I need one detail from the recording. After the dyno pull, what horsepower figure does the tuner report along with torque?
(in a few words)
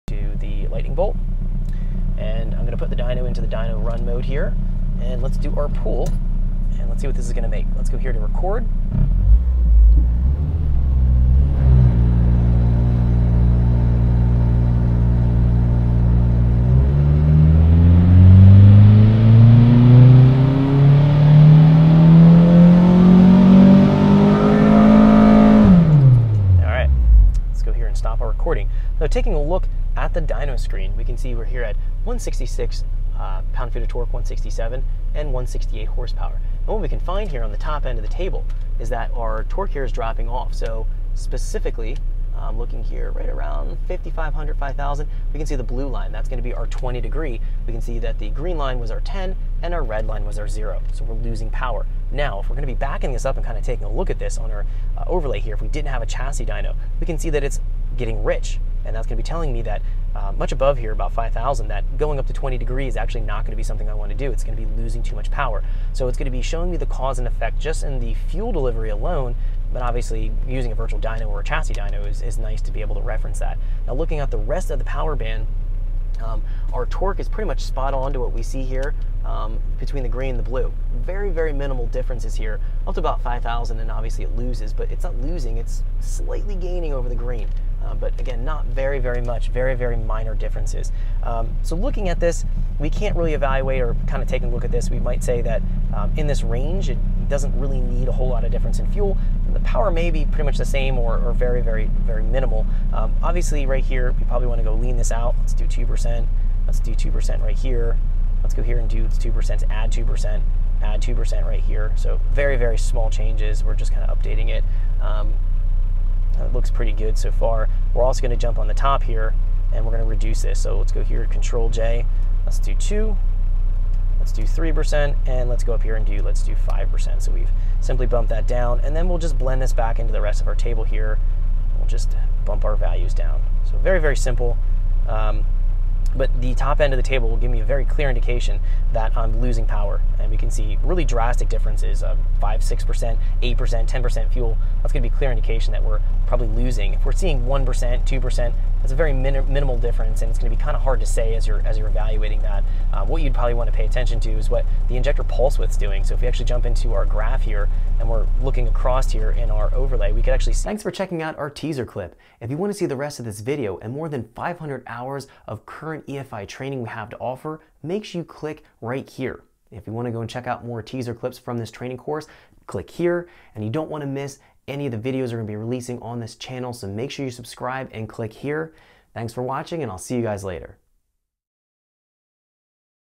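168.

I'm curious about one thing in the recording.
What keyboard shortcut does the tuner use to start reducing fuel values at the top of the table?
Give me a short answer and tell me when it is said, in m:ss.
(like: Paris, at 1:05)
Control J, at 2:01.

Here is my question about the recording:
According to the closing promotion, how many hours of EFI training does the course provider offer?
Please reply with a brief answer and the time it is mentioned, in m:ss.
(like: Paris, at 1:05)
More than 500, at 2:43.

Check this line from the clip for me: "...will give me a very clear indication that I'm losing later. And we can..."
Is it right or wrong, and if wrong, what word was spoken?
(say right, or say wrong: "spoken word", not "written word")
wrong: "power", not "later".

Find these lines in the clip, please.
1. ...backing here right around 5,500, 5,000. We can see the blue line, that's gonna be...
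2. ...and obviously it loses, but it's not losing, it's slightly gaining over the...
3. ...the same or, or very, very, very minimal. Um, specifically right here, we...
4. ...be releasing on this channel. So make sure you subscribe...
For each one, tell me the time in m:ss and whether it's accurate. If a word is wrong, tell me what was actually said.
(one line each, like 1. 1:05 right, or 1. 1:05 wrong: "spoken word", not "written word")
1. 0:42 wrong: "looking", not "backing"
2. 1:23 right
3. 1:40 wrong: "obviously", not "specifically"
4. 2:55 right.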